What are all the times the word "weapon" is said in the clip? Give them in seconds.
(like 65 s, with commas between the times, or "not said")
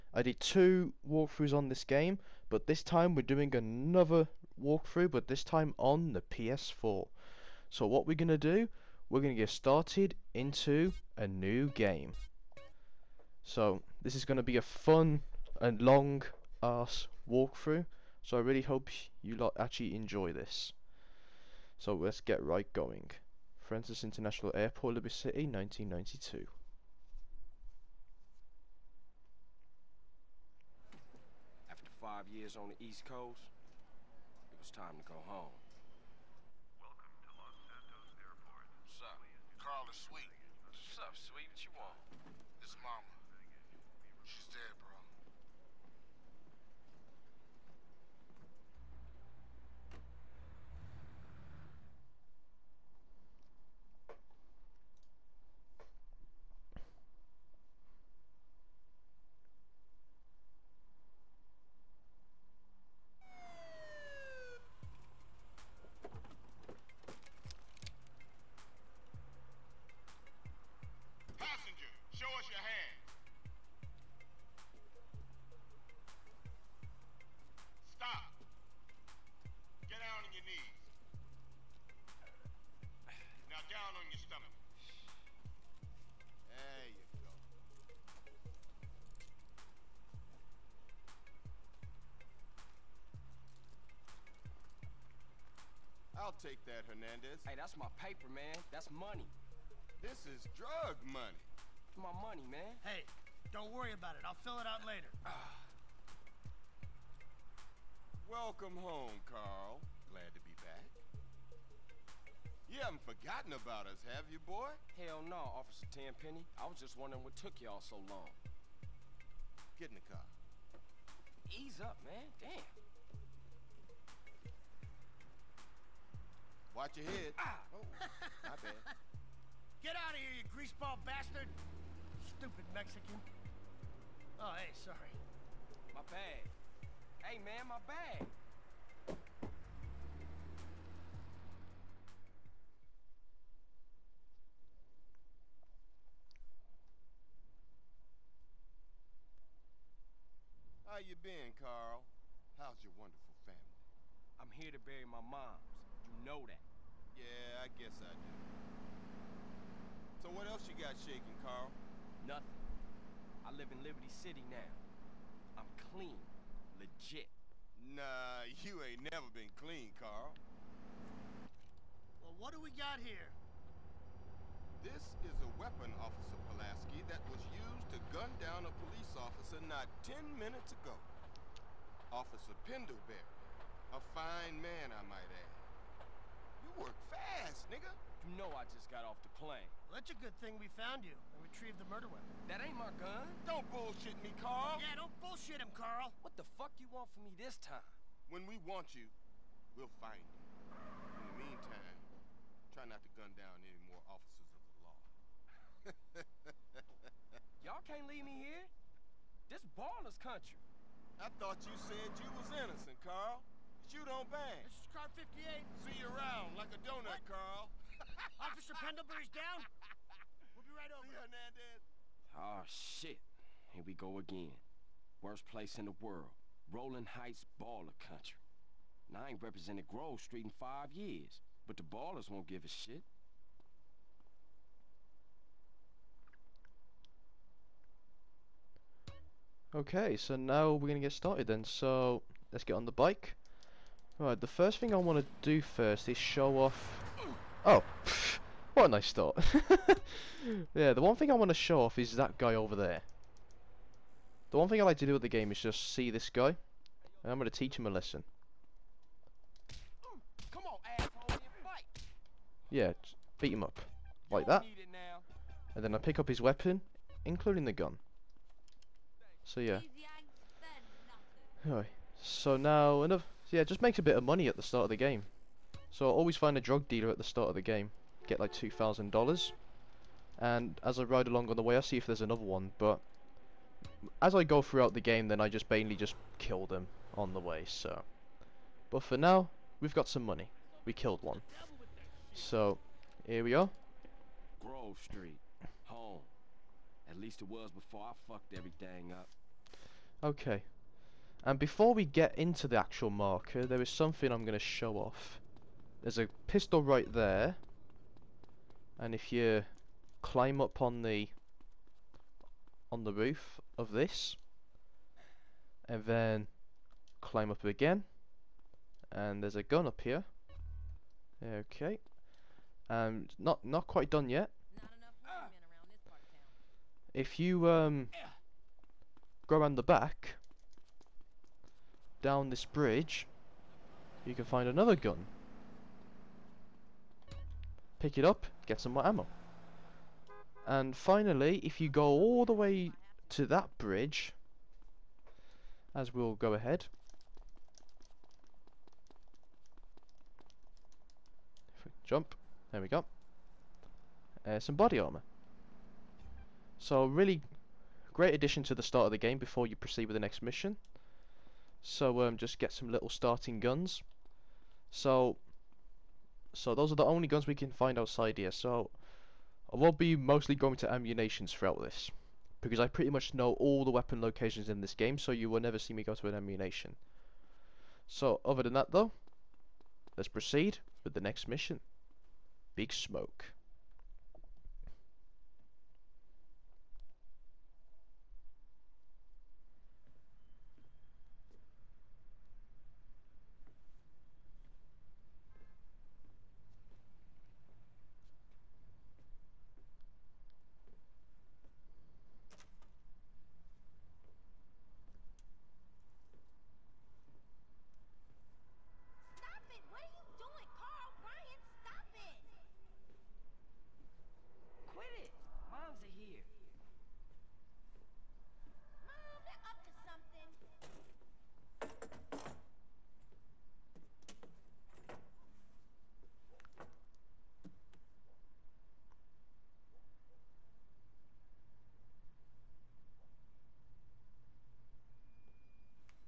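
175 s, 192 s, 266 s, 373 s.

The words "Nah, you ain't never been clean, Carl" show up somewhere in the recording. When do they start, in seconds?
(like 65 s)
167 s.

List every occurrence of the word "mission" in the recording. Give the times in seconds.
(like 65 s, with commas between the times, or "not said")
360 s, 381 s.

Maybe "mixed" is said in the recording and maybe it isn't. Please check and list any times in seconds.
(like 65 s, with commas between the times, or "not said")
not said.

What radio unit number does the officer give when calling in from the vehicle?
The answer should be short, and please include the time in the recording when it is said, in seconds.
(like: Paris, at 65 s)
58, at 214 s.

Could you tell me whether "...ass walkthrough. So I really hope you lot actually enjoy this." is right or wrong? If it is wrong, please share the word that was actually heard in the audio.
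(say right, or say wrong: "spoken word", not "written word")
right.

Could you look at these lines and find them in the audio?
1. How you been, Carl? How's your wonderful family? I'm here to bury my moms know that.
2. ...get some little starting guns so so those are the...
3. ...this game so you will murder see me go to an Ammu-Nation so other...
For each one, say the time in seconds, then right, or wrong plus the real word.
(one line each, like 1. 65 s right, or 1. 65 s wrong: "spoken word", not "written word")
1. 150 s right
2. 362 s right
3. 374 s wrong: "never", not "murder".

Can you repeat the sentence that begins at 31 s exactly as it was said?
After five years on the East Coast, it was time to go home.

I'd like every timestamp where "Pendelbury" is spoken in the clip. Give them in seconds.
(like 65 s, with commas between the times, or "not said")
182 s, 218 s.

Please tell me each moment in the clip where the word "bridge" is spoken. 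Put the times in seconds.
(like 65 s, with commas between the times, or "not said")
332 s, 343 s.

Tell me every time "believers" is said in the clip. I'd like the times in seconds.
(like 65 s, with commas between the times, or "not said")
not said.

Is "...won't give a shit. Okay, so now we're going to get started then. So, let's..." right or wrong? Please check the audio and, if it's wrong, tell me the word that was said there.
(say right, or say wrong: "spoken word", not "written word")
right.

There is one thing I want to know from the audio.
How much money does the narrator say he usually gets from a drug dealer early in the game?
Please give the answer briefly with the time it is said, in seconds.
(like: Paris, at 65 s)
$2,000, at 278 s.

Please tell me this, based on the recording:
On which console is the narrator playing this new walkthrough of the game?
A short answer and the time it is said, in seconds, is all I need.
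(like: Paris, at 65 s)
PS4, at 6 s.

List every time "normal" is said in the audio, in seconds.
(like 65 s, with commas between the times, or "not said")
not said.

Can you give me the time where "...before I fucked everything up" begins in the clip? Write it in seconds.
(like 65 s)
297 s.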